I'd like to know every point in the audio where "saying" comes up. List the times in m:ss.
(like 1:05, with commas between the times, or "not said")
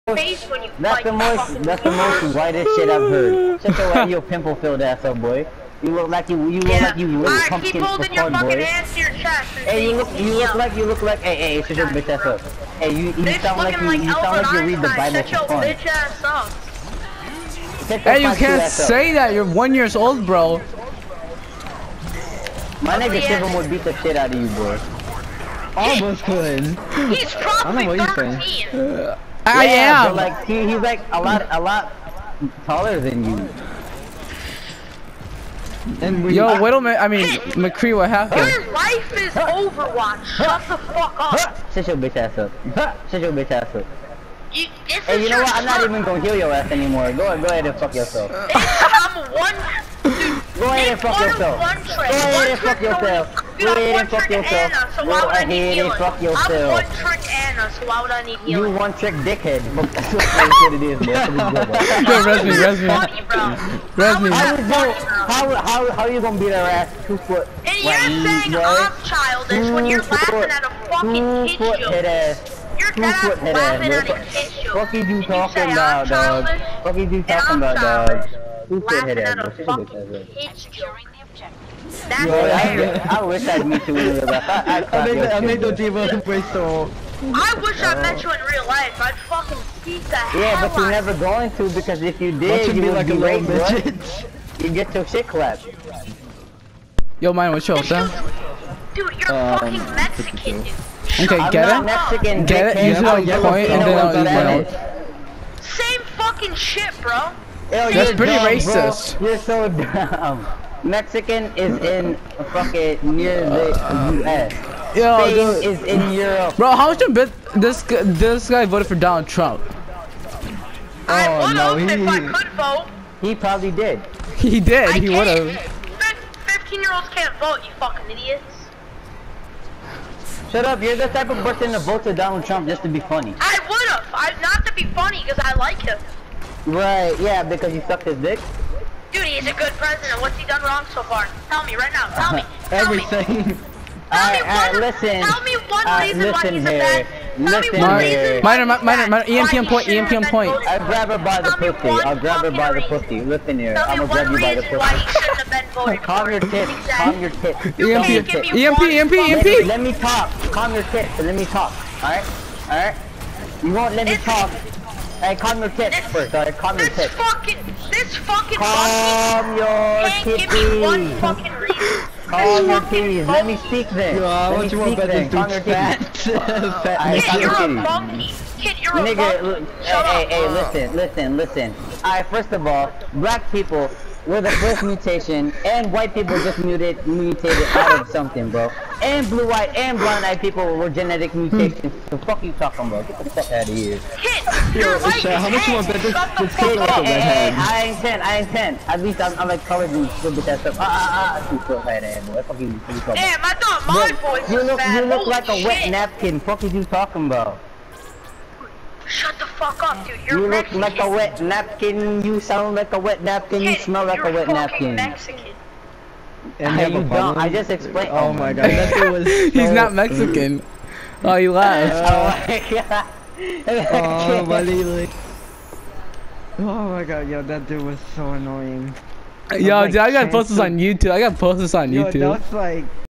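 0:28, 1:07.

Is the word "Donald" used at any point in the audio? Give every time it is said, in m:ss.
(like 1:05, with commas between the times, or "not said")
1:58, 2:12.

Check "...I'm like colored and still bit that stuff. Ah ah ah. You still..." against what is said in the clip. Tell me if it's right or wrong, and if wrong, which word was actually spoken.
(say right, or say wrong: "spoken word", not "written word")
right.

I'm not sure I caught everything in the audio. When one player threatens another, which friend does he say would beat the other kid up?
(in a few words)
Shivam.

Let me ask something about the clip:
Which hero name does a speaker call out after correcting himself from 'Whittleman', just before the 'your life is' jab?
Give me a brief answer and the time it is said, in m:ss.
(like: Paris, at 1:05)
McCree, at 0:37.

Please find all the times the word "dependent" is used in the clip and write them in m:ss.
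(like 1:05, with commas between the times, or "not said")
not said.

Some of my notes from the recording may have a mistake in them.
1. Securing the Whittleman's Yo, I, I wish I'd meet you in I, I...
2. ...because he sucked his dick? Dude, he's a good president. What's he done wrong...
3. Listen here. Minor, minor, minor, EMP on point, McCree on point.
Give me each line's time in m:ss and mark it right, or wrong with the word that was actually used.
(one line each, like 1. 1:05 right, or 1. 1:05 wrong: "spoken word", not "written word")
1. 1:20 wrong: "That", not "Whittleman"
2. 2:17 right
3. 2:27 wrong: "EMP", not "McCree".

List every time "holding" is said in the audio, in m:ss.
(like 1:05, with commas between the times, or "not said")
0:07.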